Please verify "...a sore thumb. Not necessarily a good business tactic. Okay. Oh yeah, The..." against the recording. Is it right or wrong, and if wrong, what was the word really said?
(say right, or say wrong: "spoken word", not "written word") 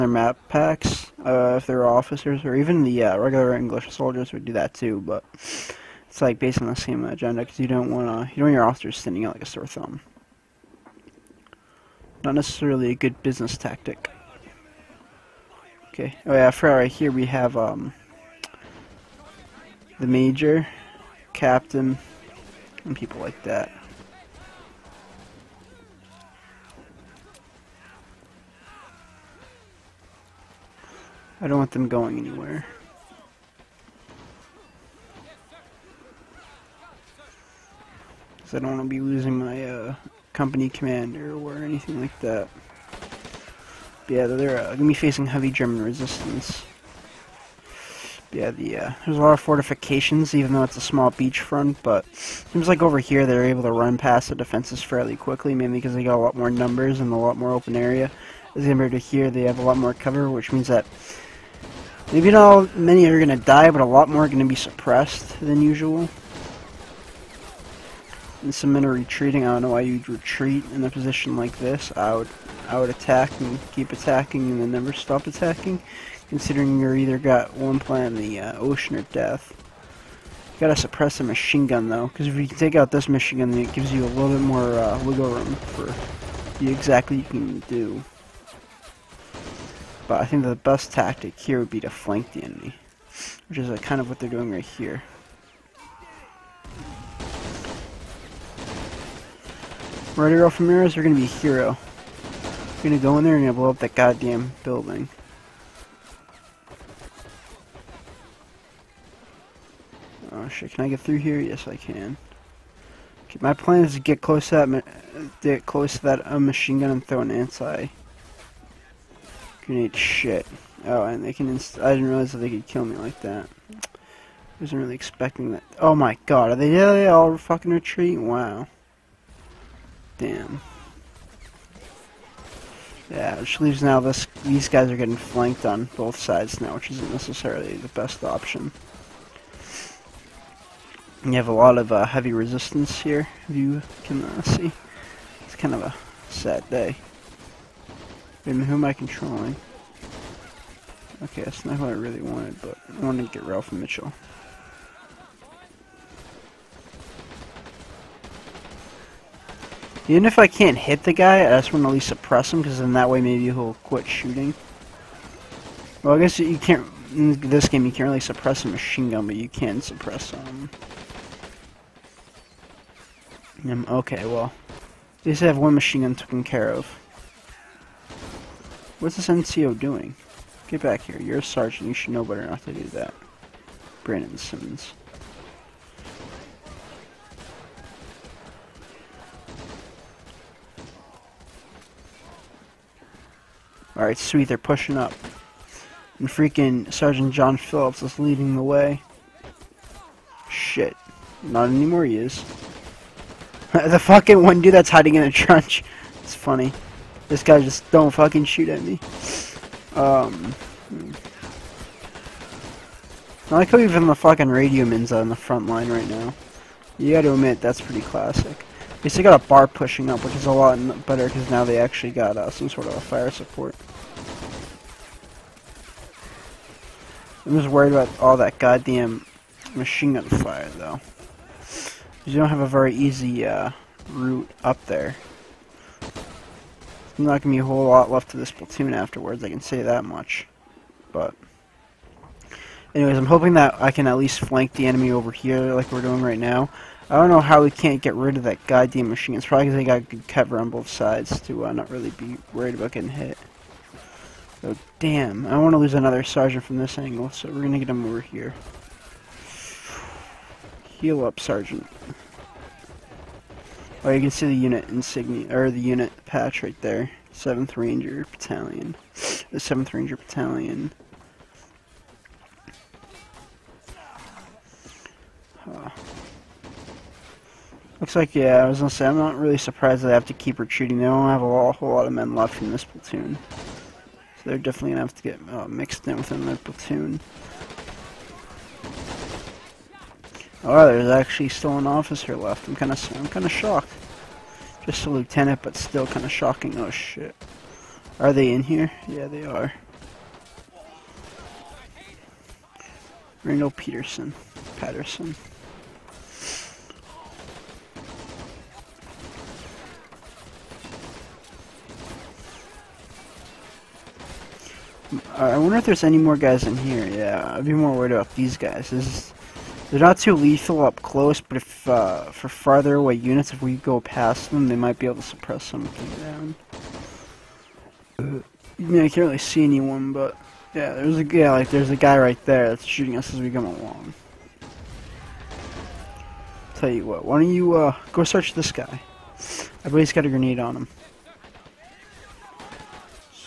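wrong: "For", not "The".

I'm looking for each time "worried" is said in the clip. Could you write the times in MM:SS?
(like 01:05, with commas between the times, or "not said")
03:47, 04:12, 05:17.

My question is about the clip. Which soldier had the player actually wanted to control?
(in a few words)
Ralph Mitchell.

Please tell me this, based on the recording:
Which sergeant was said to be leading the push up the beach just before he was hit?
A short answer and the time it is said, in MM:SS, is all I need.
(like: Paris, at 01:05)
John Phillips, at 03:16.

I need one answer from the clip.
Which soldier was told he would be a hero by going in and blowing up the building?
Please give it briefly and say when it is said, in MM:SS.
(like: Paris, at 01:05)
Ramirez, at 01:40.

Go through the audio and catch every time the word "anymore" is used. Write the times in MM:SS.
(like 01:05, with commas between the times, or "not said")
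03:21.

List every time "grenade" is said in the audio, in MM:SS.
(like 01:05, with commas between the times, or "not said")
01:59, 05:40.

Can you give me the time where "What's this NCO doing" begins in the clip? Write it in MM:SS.
02:58.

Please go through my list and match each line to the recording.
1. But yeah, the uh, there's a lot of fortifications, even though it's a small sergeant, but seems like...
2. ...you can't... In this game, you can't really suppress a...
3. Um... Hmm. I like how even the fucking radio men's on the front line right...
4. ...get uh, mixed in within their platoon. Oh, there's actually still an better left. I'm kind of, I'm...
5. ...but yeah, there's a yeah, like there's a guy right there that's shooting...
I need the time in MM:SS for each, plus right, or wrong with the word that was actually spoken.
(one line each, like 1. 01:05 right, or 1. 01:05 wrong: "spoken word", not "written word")
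1. 00:48 wrong: "beachfront", not "sergeant"
2. 02:46 right
3. 03:29 right
4. 04:45 wrong: "officer", not "better"
5. 05:30 right.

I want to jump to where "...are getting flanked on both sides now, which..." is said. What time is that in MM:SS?
02:14.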